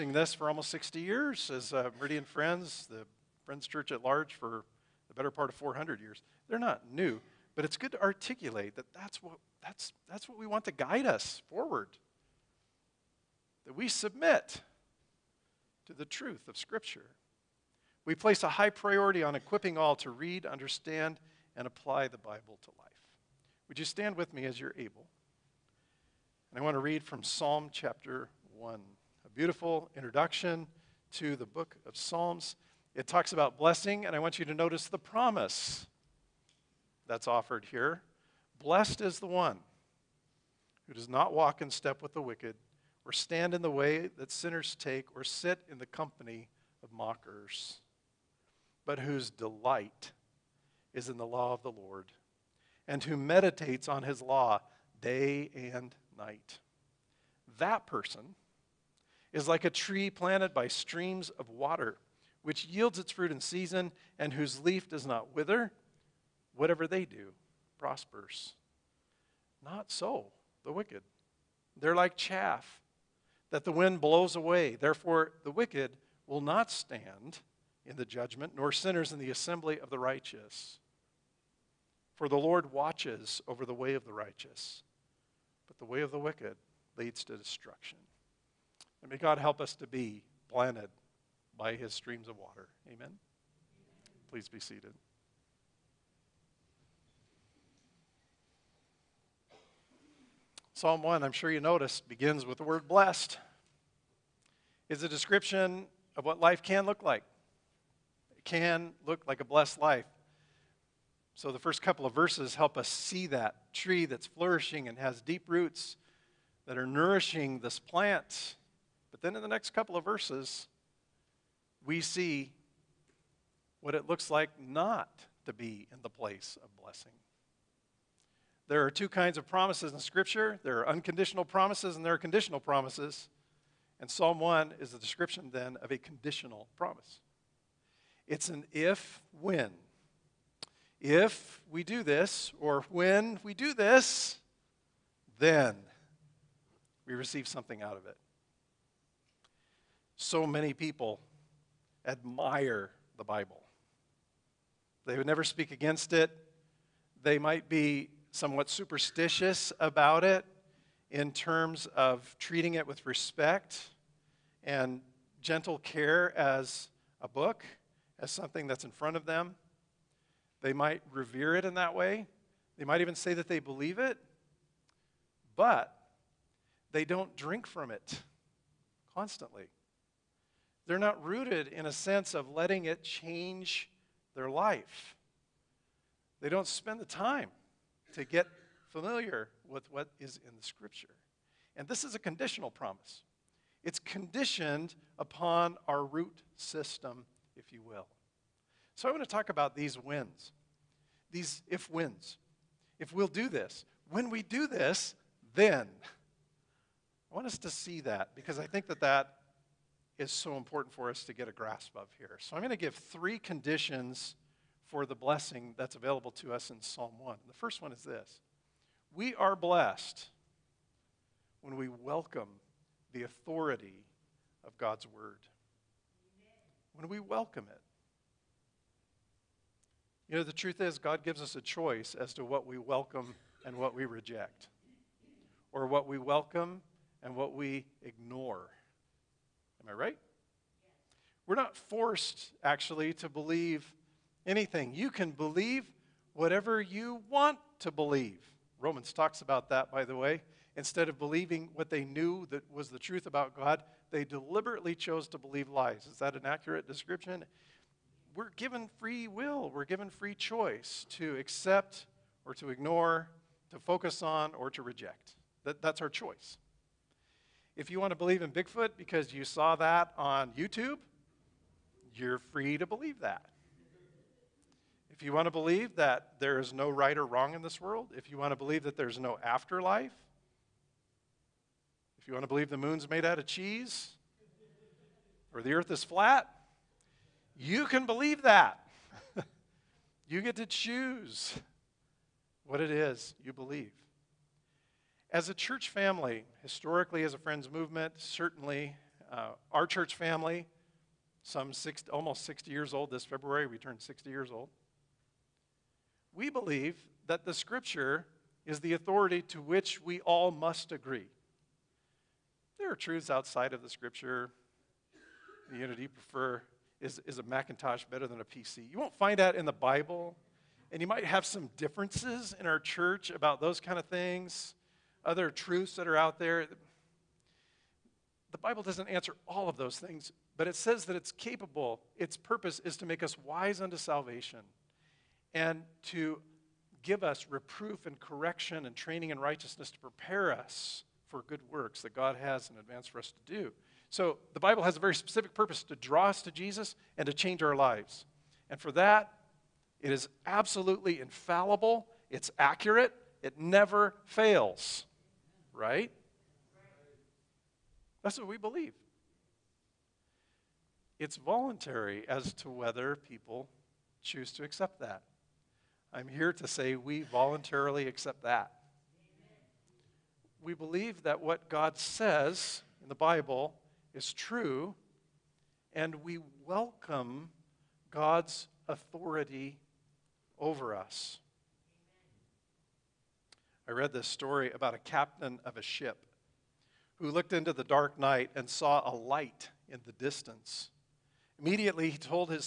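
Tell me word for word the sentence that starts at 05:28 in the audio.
The Bible doesn't answer all of those things, but it says that it's capable.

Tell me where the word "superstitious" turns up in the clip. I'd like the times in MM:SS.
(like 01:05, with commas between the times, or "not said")
02:38.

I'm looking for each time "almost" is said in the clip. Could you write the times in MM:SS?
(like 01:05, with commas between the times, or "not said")
00:00, 05:02.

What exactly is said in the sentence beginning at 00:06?
They're not new, but it's good to articulate that that's what, that's, that's what we want to guide us forward.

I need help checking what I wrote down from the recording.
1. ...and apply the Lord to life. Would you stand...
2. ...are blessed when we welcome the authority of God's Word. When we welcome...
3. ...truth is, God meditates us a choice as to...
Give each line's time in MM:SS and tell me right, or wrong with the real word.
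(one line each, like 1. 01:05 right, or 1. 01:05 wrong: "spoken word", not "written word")
1. 00:21 wrong: "Bible", not "Lord"
2. 03:39 right
3. 03:50 wrong: "gives", not "meditates".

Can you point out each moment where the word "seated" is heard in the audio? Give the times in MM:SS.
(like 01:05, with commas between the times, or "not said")
01:34.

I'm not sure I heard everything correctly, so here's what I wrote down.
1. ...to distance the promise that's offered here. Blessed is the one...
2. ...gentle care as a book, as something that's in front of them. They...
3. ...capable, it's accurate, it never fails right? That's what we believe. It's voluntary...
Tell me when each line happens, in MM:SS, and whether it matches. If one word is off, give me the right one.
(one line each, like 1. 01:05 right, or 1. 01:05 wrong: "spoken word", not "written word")
1. 00:34 wrong: "notice", not "distance"
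2. 02:45 right
3. 05:51 wrong: "infallible", not "capable".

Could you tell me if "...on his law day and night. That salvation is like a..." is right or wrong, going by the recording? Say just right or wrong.
wrong.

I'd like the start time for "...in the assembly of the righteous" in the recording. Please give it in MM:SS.
01:19.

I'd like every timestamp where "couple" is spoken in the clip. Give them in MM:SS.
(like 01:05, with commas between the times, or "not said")
01:51, 01:59.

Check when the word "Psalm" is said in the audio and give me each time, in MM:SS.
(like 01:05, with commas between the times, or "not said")
00:27, 00:31, 01:40, 02:14, 03:36.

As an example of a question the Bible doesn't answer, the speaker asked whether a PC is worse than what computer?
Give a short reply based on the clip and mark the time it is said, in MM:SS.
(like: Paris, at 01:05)
Macintosh, at 05:17.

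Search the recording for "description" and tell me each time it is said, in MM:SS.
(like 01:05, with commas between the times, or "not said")
01:45, 02:14, 04:16.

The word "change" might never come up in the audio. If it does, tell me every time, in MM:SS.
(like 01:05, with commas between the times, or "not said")
03:03, 05:47.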